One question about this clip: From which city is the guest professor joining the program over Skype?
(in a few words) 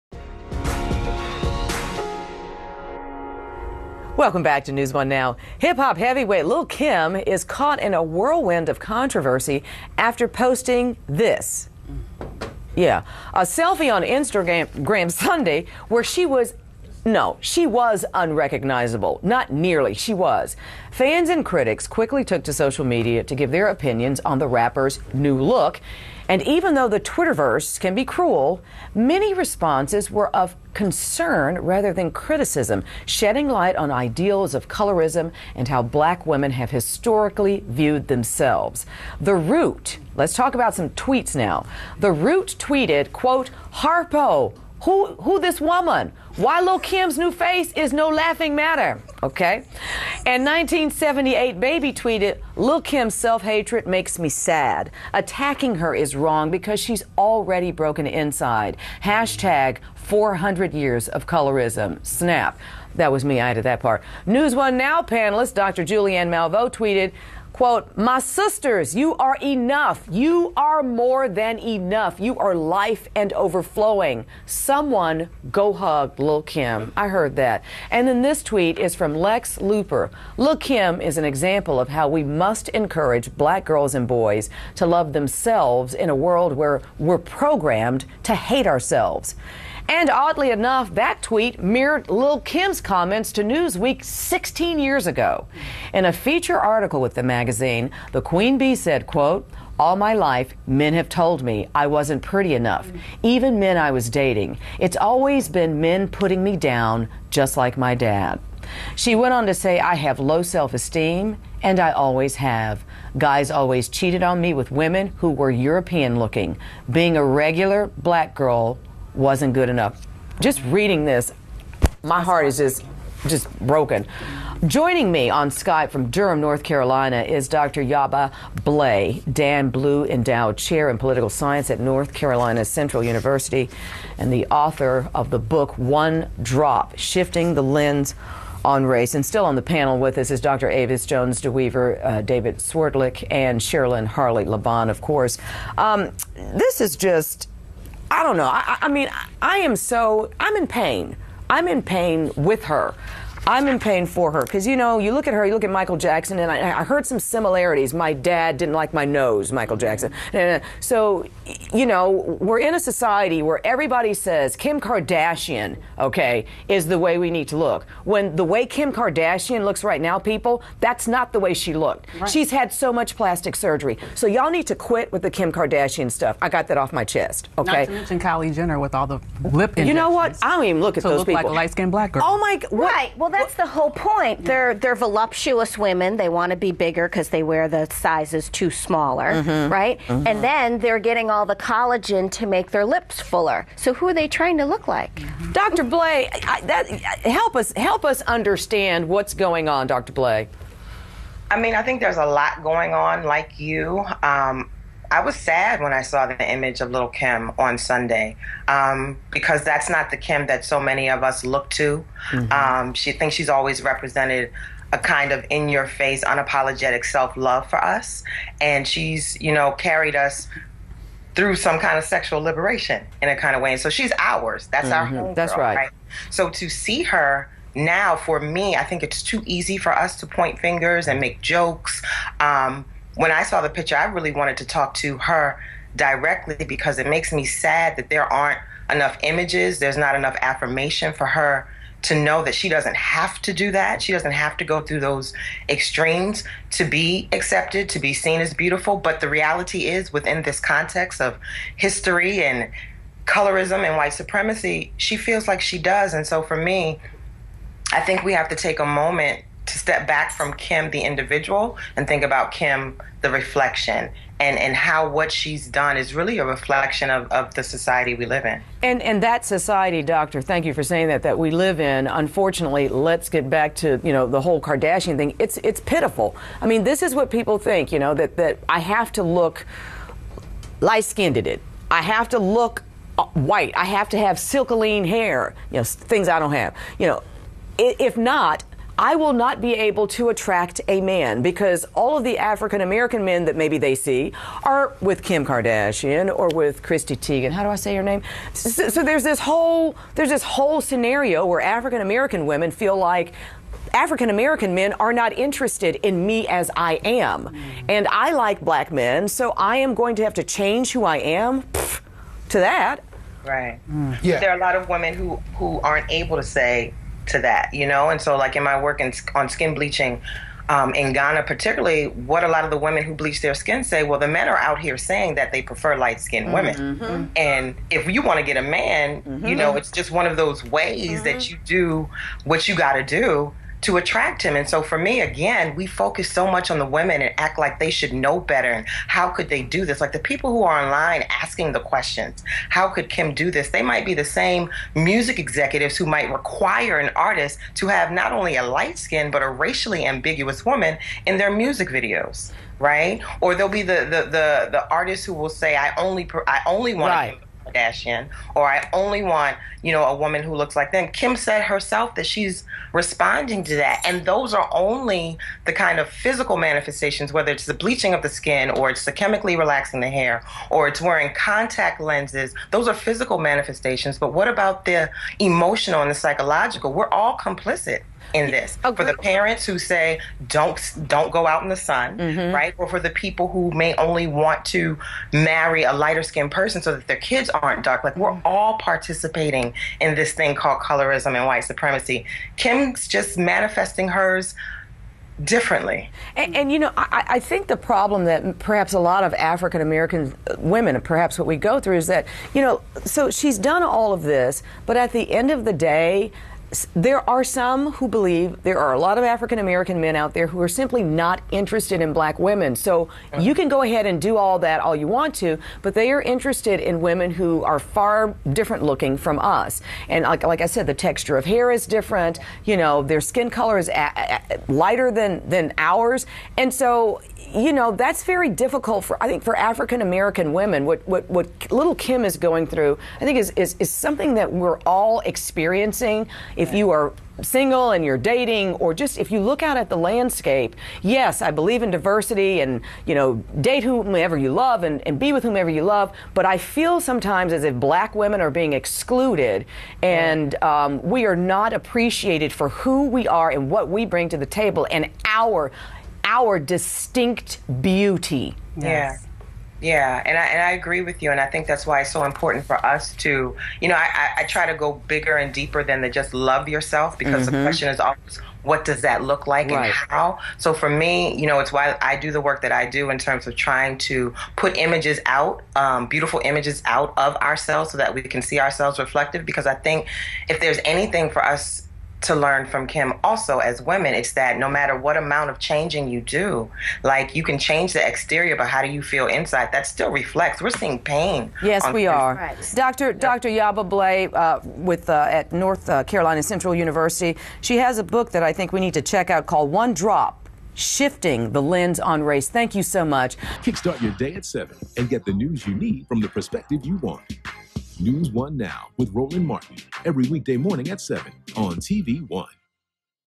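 Durham, North Carolina.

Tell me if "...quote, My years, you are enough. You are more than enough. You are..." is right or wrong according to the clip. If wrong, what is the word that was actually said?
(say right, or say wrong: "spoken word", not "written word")
wrong: "sisters", not "years".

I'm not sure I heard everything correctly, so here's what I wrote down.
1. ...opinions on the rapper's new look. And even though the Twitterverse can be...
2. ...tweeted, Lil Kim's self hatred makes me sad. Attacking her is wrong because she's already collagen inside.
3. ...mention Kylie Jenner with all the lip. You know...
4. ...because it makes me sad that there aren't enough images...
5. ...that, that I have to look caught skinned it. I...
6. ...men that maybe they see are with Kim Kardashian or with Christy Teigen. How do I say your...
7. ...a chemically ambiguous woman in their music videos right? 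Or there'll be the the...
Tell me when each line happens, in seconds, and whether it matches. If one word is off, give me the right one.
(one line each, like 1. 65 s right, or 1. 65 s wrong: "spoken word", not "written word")
1. 23 s right
2. 51 s wrong: "broken", not "collagen"
3. 177 s right
4. 236 s right
5. 278 s wrong: "light", not "caught"
6. 293 s right
7. 349 s wrong: "racially", not "chemically".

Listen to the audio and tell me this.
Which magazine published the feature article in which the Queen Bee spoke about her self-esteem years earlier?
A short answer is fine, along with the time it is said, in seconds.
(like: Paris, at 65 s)
Newsweek, at 93 s.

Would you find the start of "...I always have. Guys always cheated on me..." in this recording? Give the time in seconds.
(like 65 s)
111 s.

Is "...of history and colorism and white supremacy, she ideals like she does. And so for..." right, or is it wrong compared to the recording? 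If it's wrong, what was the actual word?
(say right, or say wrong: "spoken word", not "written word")
wrong: "feels", not "ideals".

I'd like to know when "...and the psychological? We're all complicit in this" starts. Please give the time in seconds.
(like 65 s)
376 s.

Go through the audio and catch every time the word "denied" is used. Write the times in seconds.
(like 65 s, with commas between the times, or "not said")
not said.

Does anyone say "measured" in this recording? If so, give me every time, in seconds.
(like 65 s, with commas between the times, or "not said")
not said.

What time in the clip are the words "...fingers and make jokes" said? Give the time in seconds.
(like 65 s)
230 s.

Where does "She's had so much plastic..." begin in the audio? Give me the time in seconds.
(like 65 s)
172 s.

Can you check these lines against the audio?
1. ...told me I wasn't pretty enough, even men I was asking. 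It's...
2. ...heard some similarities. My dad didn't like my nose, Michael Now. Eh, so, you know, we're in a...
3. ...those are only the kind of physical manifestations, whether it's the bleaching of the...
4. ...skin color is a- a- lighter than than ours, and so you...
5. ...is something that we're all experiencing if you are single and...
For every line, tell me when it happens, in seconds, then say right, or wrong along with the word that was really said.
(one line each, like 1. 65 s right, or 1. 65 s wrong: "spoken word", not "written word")
1. 101 s wrong: "dating", not "asking"
2. 156 s wrong: "Jackson", not "Now"
3. 364 s right
4. 423 s right
5. 433 s right.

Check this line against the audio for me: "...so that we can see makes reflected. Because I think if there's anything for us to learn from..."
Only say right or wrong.
wrong.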